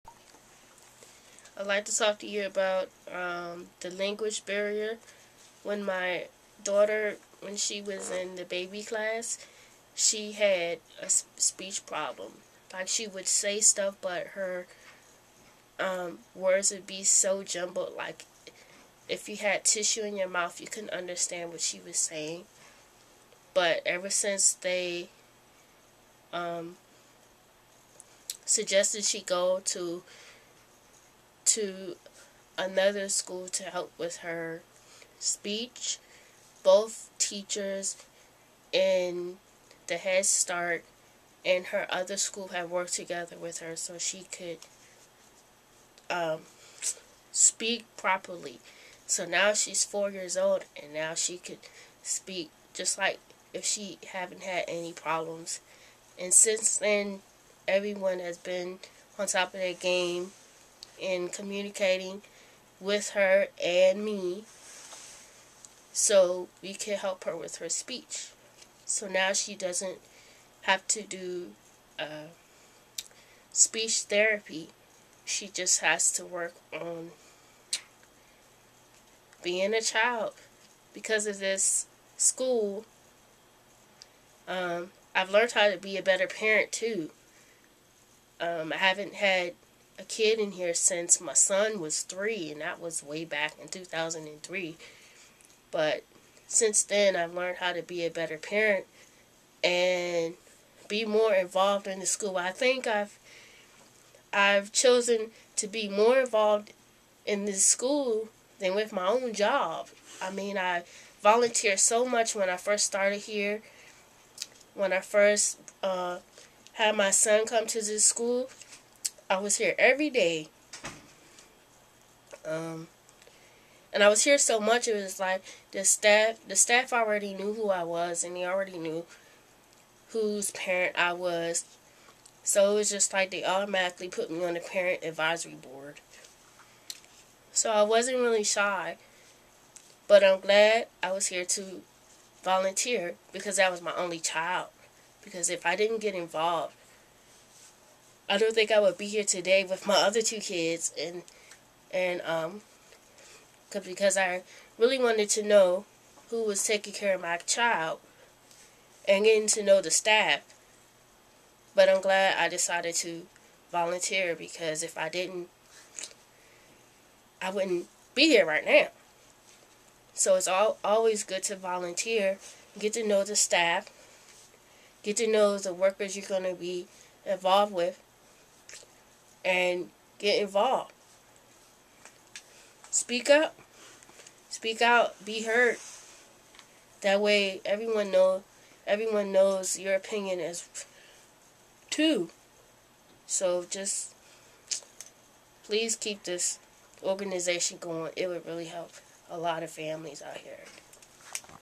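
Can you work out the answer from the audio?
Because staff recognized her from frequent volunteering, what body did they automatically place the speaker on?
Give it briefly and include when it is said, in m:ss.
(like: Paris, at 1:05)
parent advisory board, at 2:14.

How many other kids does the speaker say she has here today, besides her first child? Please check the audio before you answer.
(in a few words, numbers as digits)
2.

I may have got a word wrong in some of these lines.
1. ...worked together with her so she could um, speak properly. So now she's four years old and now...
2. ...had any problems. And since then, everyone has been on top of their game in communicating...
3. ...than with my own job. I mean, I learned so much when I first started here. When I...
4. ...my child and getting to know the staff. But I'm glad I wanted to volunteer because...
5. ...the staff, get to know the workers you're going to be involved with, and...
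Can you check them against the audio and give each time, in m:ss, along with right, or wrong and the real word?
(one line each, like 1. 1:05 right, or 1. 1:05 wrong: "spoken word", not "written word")
1. 0:42 right
2. 0:54 right
3. 1:48 wrong: "volunteered", not "learned"
4. 2:37 wrong: "decided", not "wanted"
5. 2:53 right.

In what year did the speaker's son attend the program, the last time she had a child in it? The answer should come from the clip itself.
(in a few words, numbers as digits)
2003.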